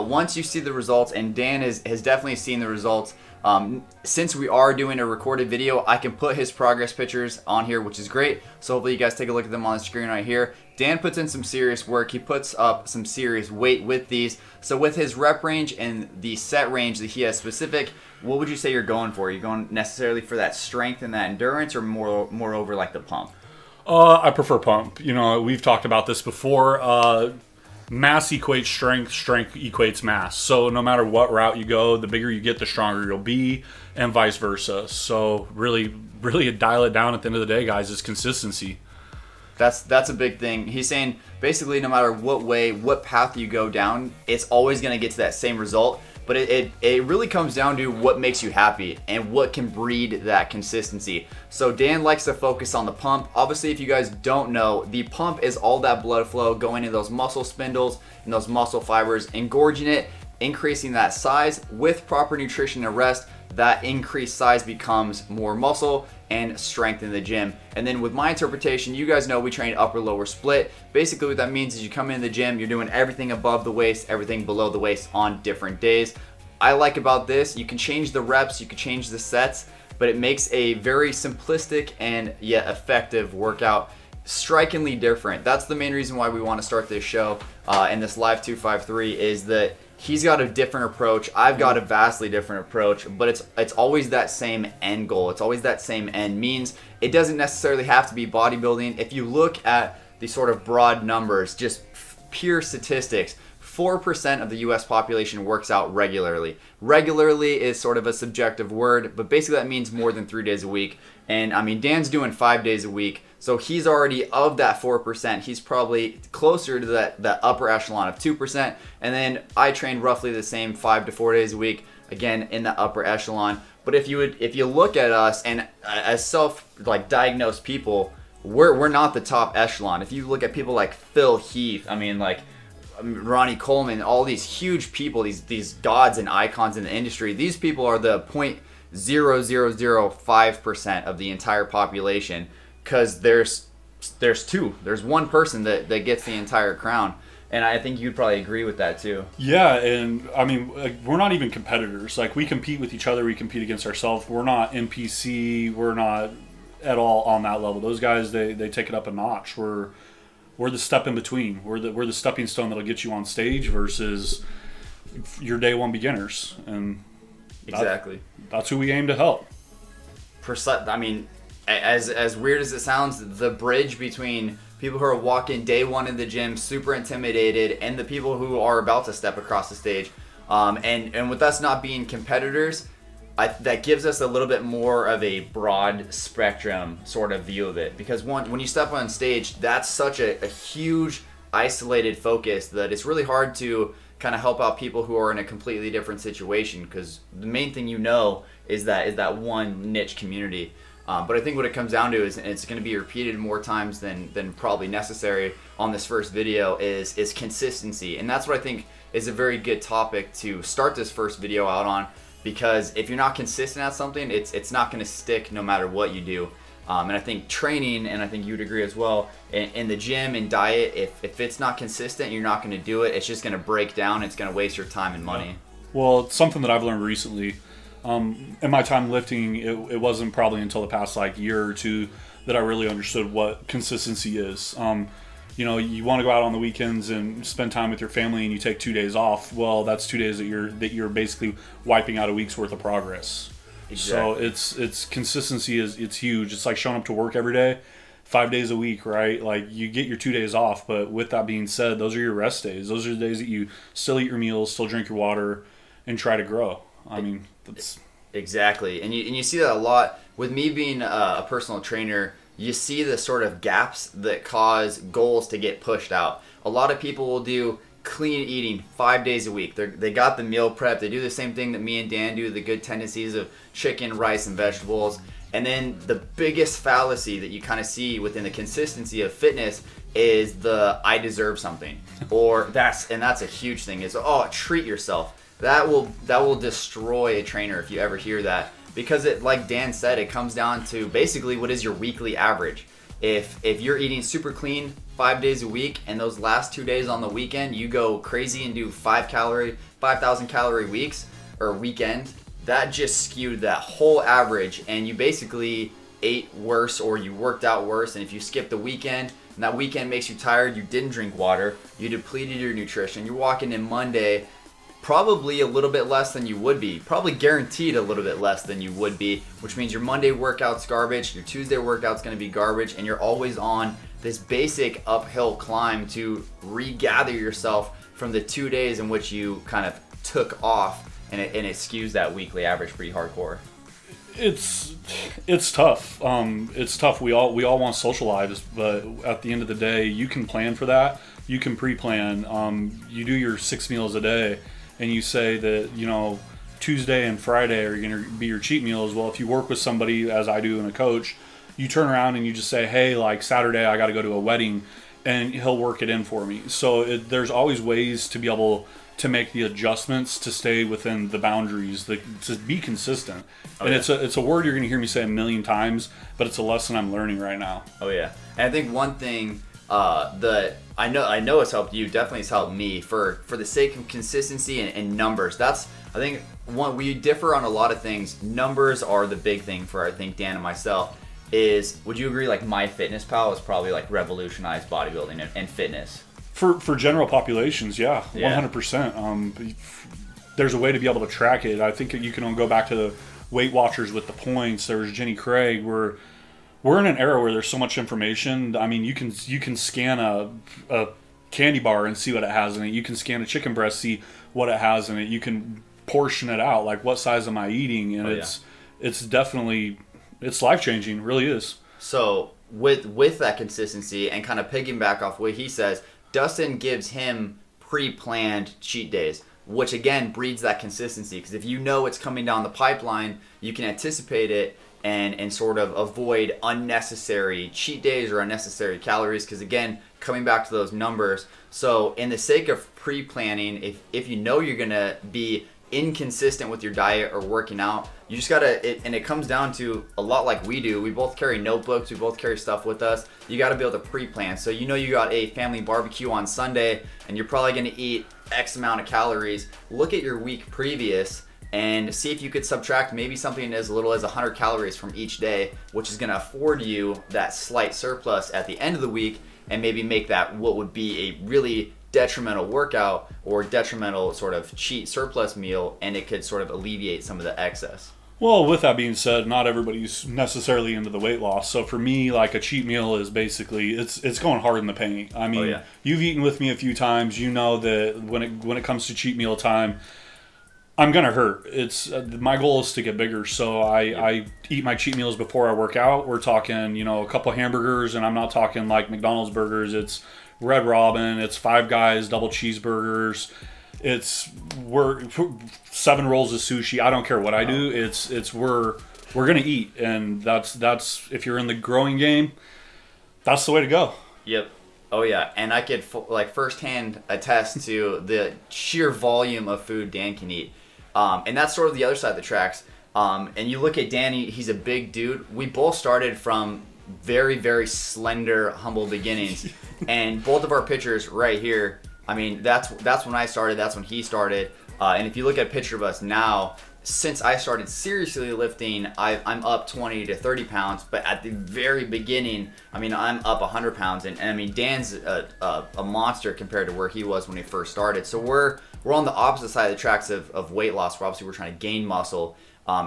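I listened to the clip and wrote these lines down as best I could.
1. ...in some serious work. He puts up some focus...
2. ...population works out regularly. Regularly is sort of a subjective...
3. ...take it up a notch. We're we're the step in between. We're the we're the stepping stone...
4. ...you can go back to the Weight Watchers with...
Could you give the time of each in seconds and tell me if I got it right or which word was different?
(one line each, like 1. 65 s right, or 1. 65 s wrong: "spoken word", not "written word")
1. 11 s wrong: "serious", not "focus"
2. 104 s right
3. 158 s right
4. 392 s right.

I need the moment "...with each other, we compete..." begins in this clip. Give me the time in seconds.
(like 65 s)
152 s.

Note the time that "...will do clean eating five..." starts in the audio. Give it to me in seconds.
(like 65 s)
267 s.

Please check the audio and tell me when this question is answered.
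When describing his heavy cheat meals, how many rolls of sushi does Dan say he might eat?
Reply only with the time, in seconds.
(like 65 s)
495 s.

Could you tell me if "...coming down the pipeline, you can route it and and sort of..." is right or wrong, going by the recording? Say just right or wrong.
wrong.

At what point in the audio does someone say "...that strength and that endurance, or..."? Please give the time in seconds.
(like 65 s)
20 s.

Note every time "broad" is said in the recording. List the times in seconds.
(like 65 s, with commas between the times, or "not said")
100 s, 185 s.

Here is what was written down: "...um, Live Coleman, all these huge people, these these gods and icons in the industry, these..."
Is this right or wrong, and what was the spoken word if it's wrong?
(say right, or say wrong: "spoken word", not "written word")
wrong: "Ronnie", not "Live".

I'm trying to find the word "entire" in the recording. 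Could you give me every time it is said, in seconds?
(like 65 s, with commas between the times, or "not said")
141 s, 146 s.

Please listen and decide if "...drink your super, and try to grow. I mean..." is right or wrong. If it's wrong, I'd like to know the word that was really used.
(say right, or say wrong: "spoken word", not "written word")
wrong: "water", not "super".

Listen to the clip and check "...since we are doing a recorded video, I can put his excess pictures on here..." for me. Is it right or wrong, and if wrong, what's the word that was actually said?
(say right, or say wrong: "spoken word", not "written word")
wrong: "progress", not "excess".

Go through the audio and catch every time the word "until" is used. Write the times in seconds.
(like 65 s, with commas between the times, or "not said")
230 s.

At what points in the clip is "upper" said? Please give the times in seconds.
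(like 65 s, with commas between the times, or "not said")
69 s, 117 s, 122 s.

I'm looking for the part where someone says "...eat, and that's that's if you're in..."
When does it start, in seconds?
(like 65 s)
499 s.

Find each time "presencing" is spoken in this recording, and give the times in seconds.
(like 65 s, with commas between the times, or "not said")
not said.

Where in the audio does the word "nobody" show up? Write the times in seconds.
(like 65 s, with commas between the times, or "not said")
not said.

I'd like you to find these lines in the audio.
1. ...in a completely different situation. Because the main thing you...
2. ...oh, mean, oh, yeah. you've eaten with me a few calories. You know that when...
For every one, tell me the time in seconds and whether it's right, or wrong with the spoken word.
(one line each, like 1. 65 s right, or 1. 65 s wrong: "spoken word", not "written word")
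1. 195 s right
2. 475 s wrong: "times", not "calories".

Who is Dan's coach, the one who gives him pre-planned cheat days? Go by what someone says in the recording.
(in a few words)
Dustin.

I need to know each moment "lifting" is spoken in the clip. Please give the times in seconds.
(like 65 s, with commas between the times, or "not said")
229 s, 528 s.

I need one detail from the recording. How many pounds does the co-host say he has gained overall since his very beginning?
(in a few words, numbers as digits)
100 pounds.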